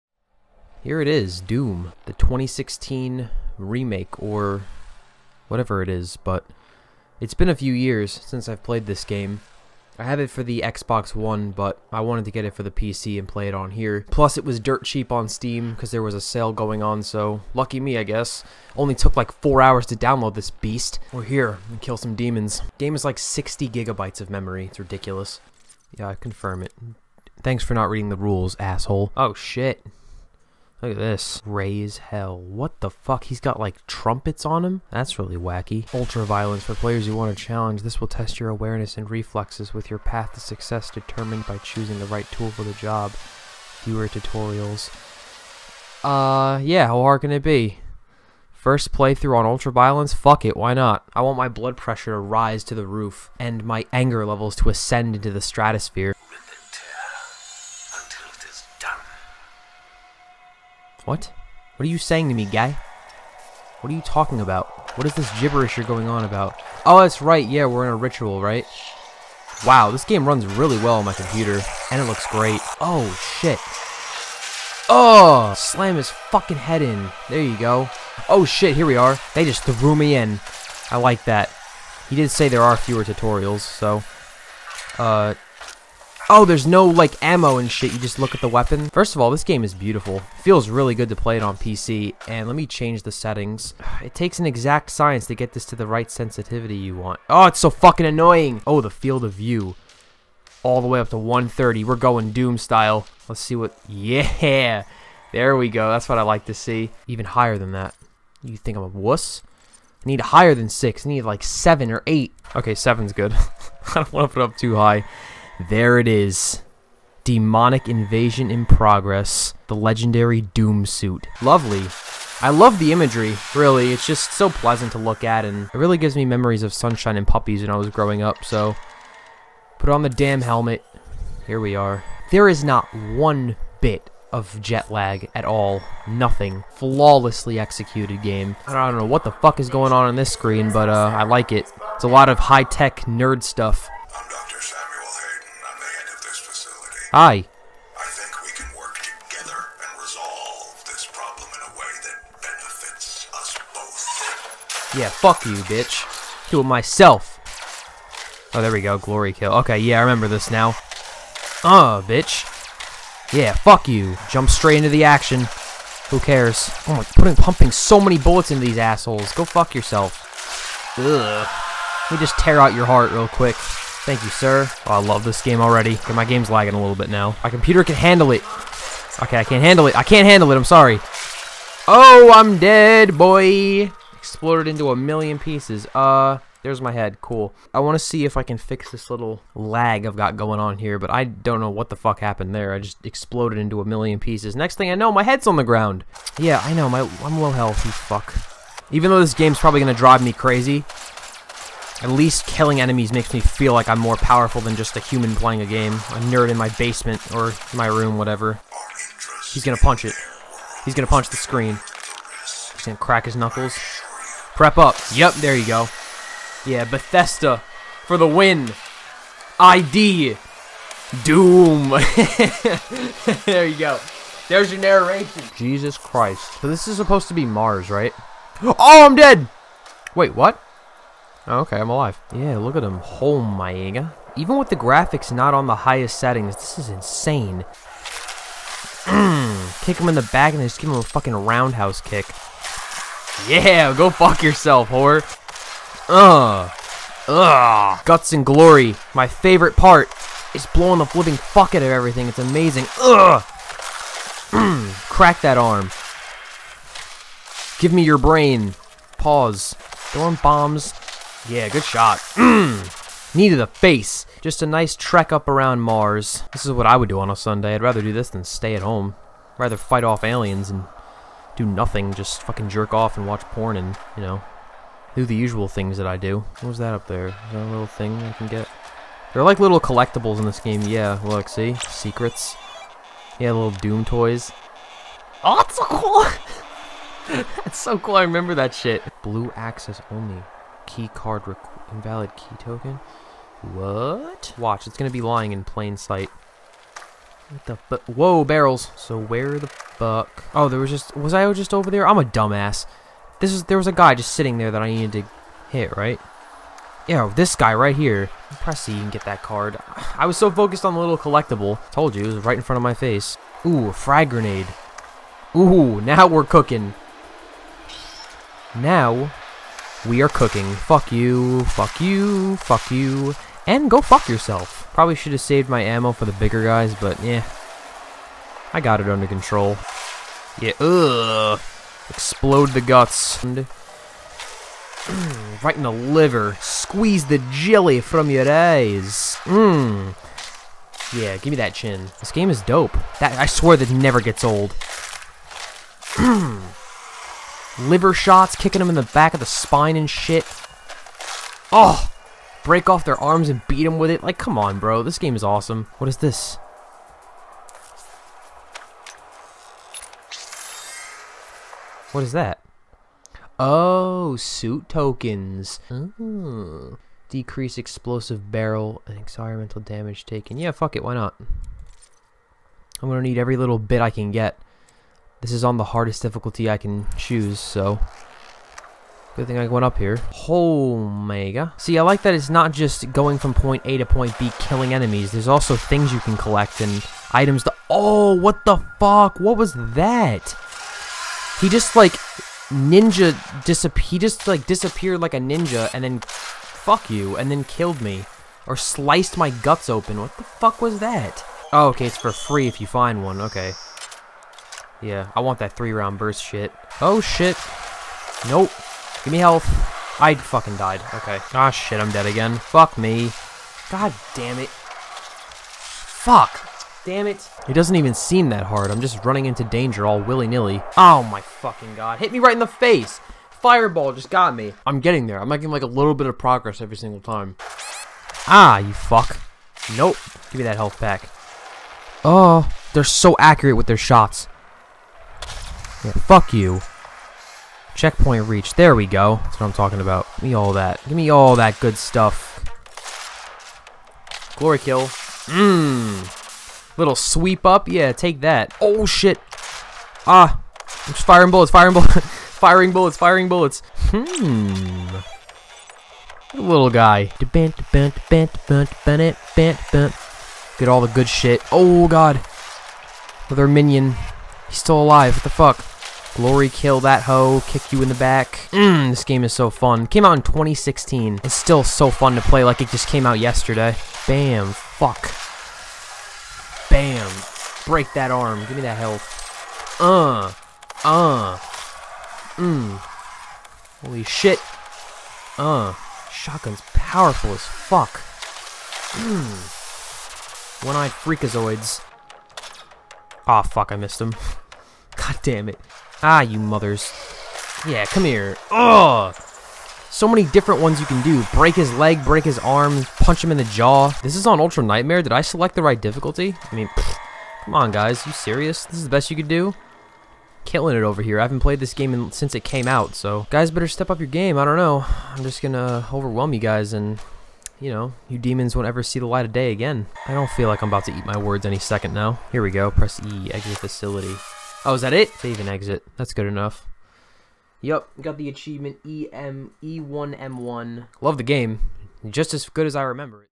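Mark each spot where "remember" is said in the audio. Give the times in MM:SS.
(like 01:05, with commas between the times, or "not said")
02:40, 04:48, 08:53.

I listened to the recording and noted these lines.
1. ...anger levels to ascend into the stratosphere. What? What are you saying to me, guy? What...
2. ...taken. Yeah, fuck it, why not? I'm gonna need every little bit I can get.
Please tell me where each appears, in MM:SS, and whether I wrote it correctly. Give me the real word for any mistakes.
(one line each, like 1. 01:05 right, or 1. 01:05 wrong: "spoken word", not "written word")
1. 00:53 right
2. 06:10 right.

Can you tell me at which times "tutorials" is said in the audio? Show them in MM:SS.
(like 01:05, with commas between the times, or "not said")
00:44, 01:23.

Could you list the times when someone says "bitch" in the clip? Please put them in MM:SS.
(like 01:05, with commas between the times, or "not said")
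02:35, 02:42.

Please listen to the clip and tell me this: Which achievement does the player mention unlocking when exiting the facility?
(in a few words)
E1M1.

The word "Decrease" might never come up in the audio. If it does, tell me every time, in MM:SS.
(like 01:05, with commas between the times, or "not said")
06:07.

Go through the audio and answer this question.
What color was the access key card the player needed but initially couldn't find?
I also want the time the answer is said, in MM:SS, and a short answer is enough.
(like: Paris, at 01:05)
Blue, at 04:49.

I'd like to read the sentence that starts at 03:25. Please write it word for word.
A nerd in my basement or my room, whatever.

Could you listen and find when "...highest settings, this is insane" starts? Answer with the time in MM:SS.
03:55.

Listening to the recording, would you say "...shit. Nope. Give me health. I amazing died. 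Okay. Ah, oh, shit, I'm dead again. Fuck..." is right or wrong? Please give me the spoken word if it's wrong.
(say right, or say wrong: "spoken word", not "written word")
wrong: "fucking", not "amazing".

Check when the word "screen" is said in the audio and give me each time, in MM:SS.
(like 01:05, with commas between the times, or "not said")
02:20, 03:31.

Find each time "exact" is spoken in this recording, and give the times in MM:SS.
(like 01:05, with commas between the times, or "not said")
01:34.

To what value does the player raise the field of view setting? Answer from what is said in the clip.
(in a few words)
130.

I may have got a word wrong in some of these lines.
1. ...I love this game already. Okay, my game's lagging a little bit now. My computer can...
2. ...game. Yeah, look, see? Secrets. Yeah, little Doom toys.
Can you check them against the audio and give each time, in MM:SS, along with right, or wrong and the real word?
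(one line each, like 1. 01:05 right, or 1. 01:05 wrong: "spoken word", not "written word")
1. 02:54 right
2. 04:40 right.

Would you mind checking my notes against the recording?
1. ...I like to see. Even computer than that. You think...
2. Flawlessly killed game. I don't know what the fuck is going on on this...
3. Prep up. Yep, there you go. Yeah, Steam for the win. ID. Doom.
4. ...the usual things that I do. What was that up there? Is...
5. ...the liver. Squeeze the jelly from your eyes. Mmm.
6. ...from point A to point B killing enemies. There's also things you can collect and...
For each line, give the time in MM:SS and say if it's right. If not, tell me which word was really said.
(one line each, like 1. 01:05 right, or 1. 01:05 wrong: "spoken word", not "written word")
1. 01:46 wrong: "higher", not "computer"
2. 02:16 wrong: "executed", not "killed"
3. 03:34 wrong: "Bethesda", not "Steam"
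4. 04:35 right
5. 05:35 right
6. 06:23 right.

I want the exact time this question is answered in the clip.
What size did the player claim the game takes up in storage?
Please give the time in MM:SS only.
00:23.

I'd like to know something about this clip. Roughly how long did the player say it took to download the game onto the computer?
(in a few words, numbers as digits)
4 hours.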